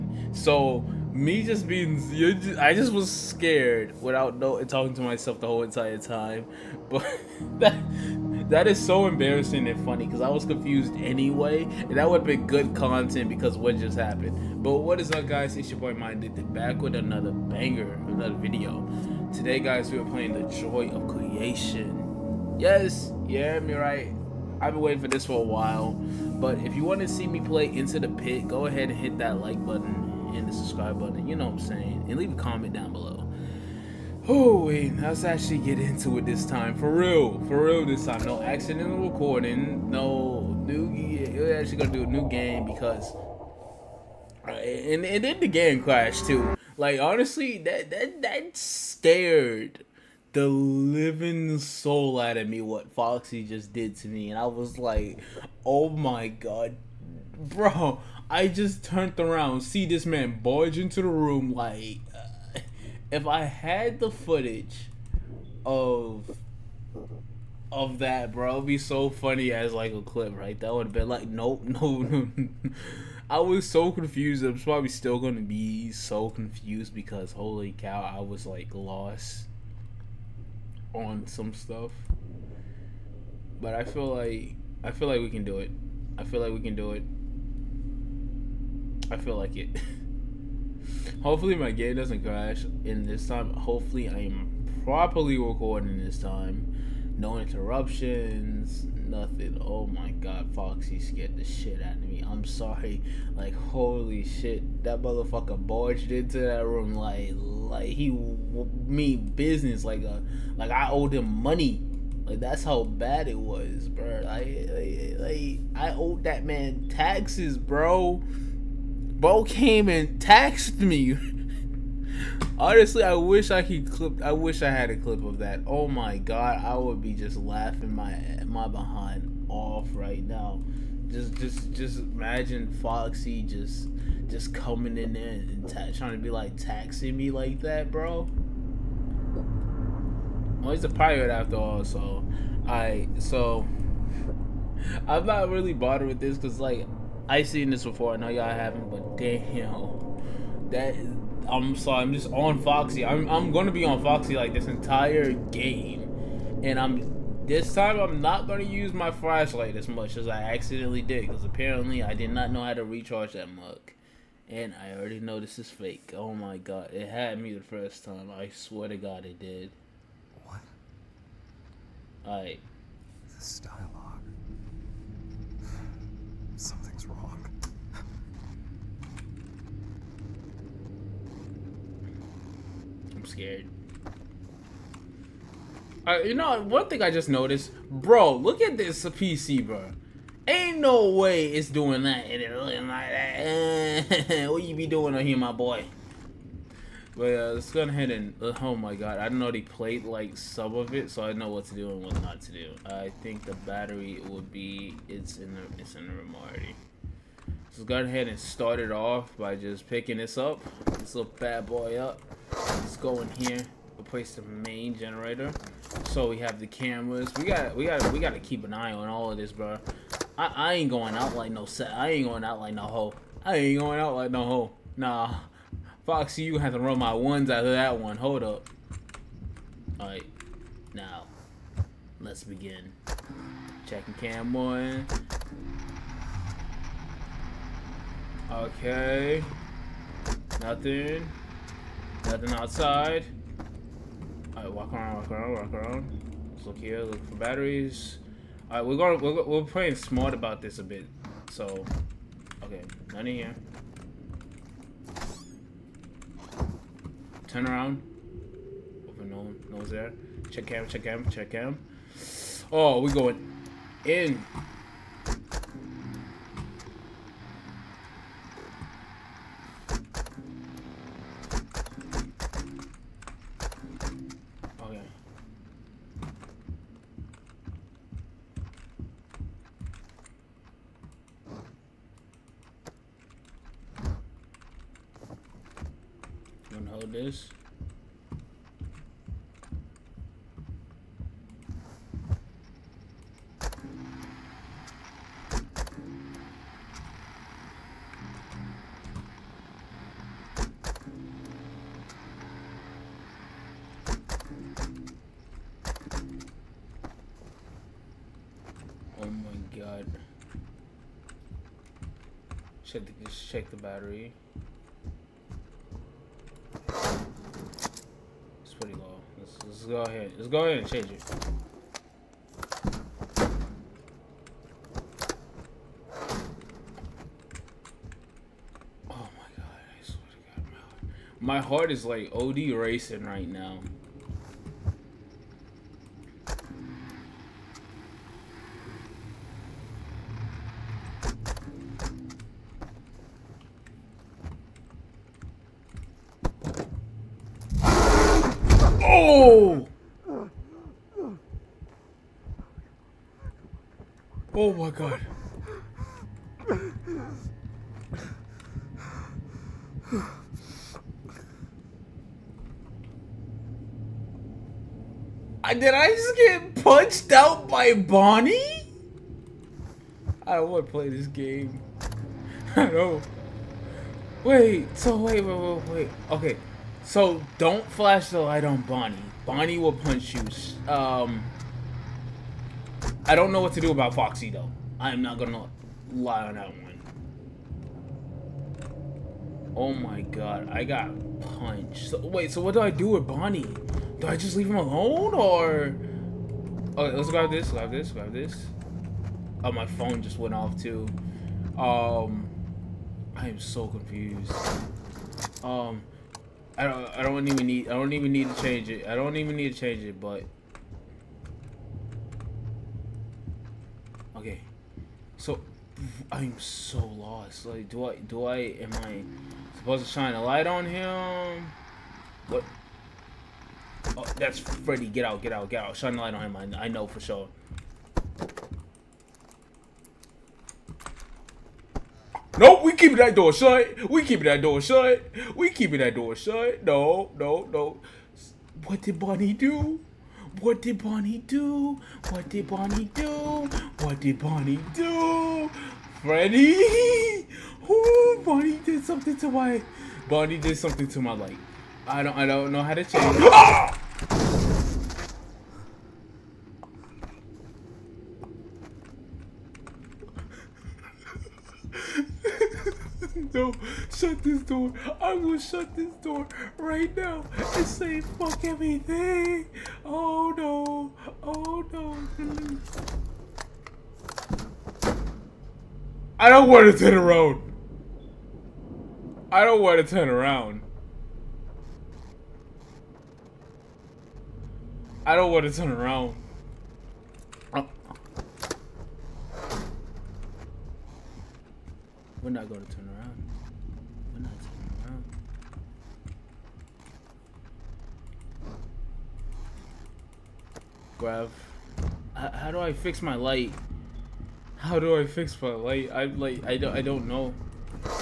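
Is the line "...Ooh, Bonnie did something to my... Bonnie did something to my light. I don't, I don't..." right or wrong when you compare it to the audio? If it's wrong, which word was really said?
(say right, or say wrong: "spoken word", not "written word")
right.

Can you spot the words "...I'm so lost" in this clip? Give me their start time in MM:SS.
06:56.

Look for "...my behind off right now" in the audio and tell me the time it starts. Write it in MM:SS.
02:08.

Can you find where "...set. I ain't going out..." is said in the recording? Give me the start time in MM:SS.
03:41.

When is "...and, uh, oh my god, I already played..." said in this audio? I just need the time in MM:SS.
03:18.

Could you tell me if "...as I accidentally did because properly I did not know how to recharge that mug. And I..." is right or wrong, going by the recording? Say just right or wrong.
wrong.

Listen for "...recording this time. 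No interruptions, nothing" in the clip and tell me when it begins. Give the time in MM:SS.
01:35.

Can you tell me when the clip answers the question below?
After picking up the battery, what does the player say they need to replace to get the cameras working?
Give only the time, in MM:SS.
03:34.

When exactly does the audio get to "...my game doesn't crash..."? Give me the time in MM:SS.
01:31.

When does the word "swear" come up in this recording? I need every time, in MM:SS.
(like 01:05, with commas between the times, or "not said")
02:48, 05:30.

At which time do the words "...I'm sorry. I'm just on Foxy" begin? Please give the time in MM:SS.
02:31.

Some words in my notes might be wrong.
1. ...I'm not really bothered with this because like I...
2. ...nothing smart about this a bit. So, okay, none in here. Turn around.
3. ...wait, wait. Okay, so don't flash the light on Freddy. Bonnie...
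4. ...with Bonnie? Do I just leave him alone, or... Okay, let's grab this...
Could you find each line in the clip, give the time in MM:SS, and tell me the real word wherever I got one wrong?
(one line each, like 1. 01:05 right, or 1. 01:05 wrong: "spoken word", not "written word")
1. 02:25 right
2. 04:09 wrong: "playing", not "nothing"
3. 06:15 wrong: "Bonnie", not "Freddy"
4. 06:33 right.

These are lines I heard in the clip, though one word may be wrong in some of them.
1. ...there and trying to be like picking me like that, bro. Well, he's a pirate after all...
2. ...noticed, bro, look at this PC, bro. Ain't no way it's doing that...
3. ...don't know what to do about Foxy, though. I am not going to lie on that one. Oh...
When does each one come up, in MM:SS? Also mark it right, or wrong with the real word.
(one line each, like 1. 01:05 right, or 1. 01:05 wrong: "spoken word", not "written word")
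1. 02:15 wrong: "taxing", not "picking"
2. 03:07 right
3. 06:23 right.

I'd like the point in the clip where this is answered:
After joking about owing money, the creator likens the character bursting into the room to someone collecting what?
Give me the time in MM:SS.
01:56.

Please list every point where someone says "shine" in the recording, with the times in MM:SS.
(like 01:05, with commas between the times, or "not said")
07:00, 07:05.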